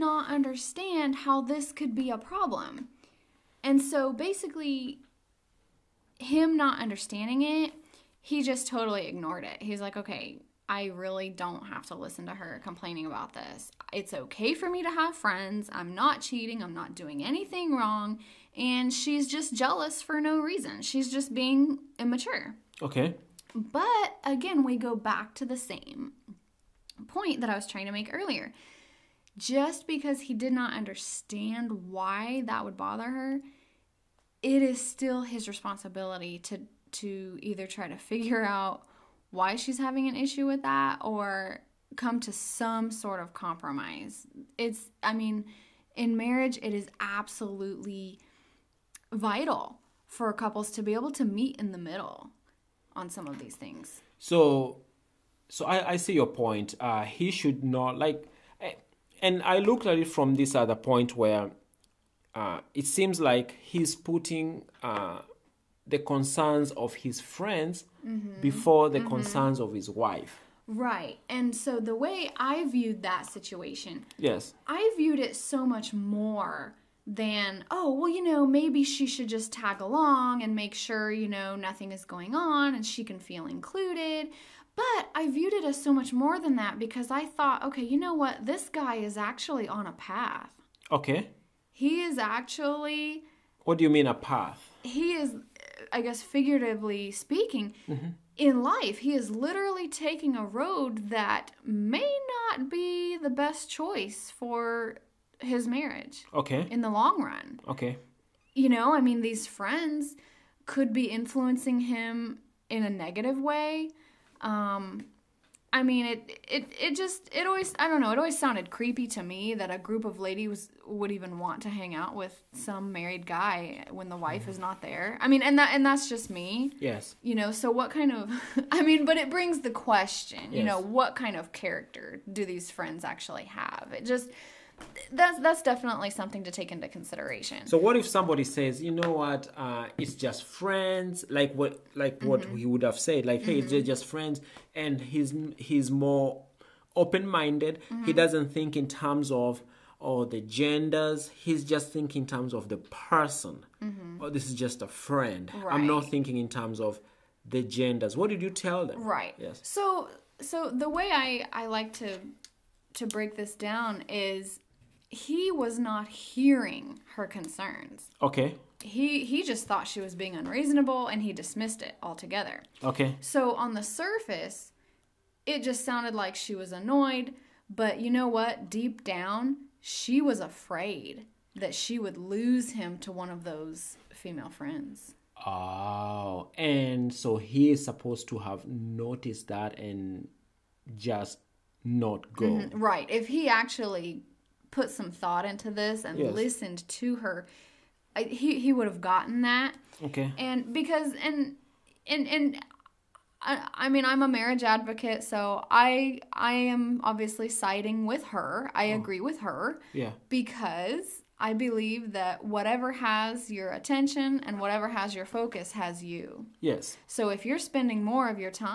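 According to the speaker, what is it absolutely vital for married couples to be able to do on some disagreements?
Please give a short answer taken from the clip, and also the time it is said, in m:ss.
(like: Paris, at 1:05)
meet in the middle, at 0:51.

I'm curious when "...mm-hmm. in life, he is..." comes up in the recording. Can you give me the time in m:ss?
1:37.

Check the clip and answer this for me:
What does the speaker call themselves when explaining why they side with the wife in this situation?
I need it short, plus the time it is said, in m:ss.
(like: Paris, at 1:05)
marriage advocate, at 3:24.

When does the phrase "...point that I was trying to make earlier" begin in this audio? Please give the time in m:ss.
0:27.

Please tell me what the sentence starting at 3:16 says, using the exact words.
listened to her, I, he he would have gotten that.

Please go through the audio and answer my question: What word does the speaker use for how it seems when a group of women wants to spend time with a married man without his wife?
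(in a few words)
creepy.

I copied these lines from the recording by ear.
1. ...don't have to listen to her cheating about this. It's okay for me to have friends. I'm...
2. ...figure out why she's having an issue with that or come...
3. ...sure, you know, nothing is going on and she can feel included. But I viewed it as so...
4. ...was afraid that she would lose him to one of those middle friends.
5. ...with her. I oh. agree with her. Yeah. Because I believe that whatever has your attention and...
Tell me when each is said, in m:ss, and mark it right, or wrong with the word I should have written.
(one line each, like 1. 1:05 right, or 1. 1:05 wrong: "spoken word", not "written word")
1. 0:11 wrong: "complaining", not "cheating"
2. 0:37 right
3. 1:20 right
4. 3:00 wrong: "female", not "middle"
5. 3:28 right.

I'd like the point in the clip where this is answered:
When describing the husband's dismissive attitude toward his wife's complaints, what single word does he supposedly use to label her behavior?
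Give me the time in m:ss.
0:21.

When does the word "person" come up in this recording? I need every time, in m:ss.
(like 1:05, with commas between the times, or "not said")
2:32.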